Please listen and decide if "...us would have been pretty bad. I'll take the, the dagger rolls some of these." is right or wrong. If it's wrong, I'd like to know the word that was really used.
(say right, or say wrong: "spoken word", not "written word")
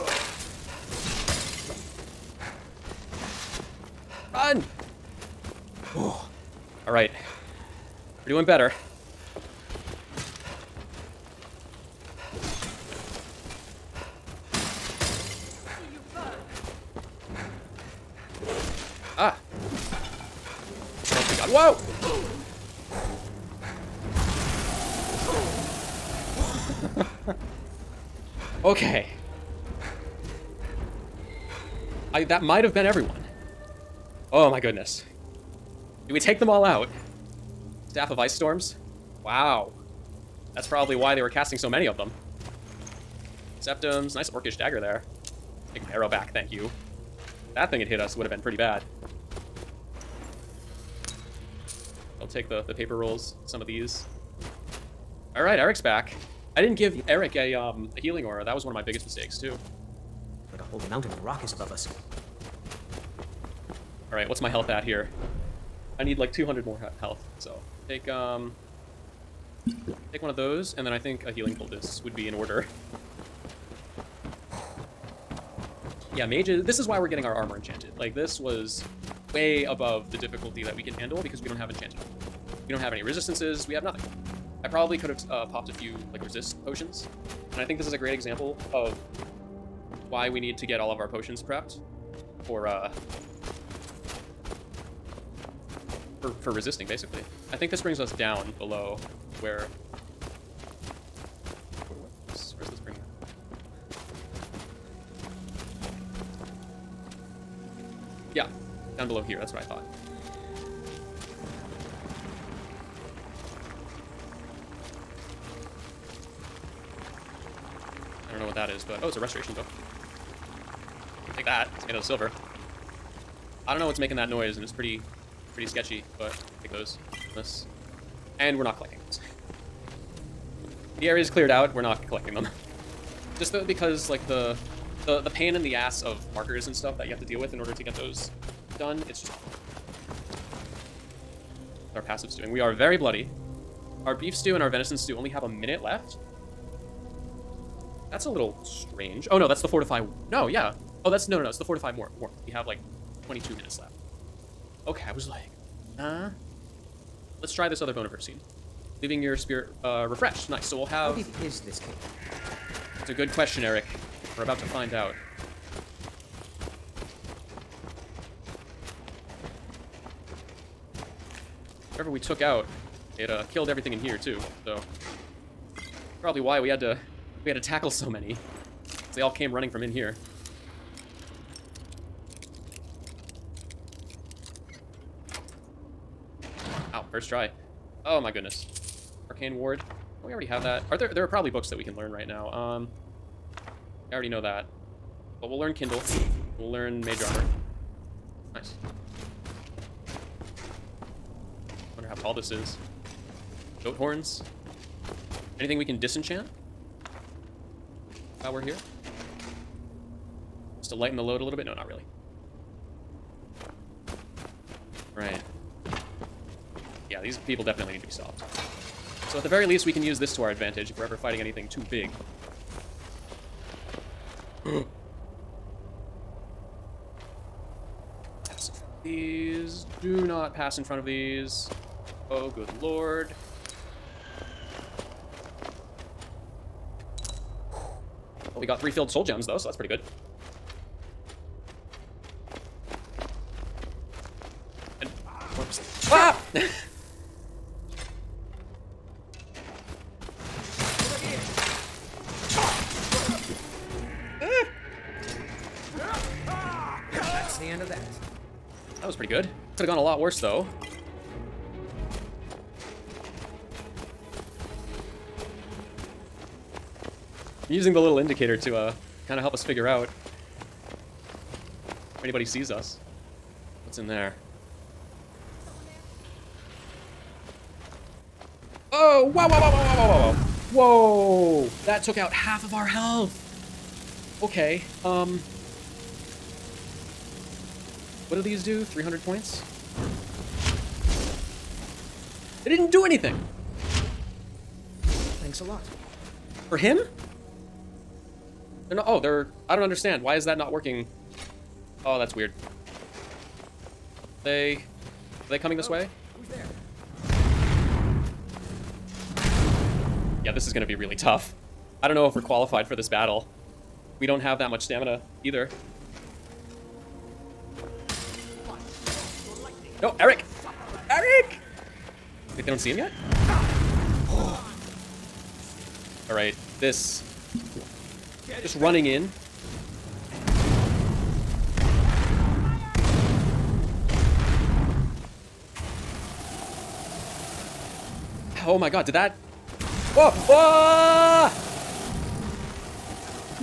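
wrong: "paper", not "dagger".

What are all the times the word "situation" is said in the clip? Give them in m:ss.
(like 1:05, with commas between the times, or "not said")
not said.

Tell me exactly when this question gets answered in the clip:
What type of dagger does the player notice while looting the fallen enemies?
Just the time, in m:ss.
0:44.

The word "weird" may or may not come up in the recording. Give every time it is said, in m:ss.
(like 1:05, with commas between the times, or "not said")
5:02.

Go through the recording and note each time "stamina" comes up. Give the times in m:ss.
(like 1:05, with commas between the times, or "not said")
5:14.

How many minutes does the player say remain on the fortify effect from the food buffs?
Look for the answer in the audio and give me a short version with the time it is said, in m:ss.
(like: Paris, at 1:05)
22, at 2:33.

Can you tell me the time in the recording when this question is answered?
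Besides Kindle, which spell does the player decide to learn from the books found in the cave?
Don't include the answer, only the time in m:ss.
3:17.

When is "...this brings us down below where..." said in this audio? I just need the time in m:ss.
1:37.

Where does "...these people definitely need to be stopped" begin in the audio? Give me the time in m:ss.
3:37.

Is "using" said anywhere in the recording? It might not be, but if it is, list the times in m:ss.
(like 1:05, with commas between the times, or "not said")
4:27.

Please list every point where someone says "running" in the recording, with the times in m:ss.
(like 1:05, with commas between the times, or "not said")
2:59, 5:28.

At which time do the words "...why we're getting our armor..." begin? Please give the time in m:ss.
1:16.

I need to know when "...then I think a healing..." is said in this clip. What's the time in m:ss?
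1:10.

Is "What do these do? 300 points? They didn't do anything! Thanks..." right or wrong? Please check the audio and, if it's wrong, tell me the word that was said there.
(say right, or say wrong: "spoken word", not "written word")
right.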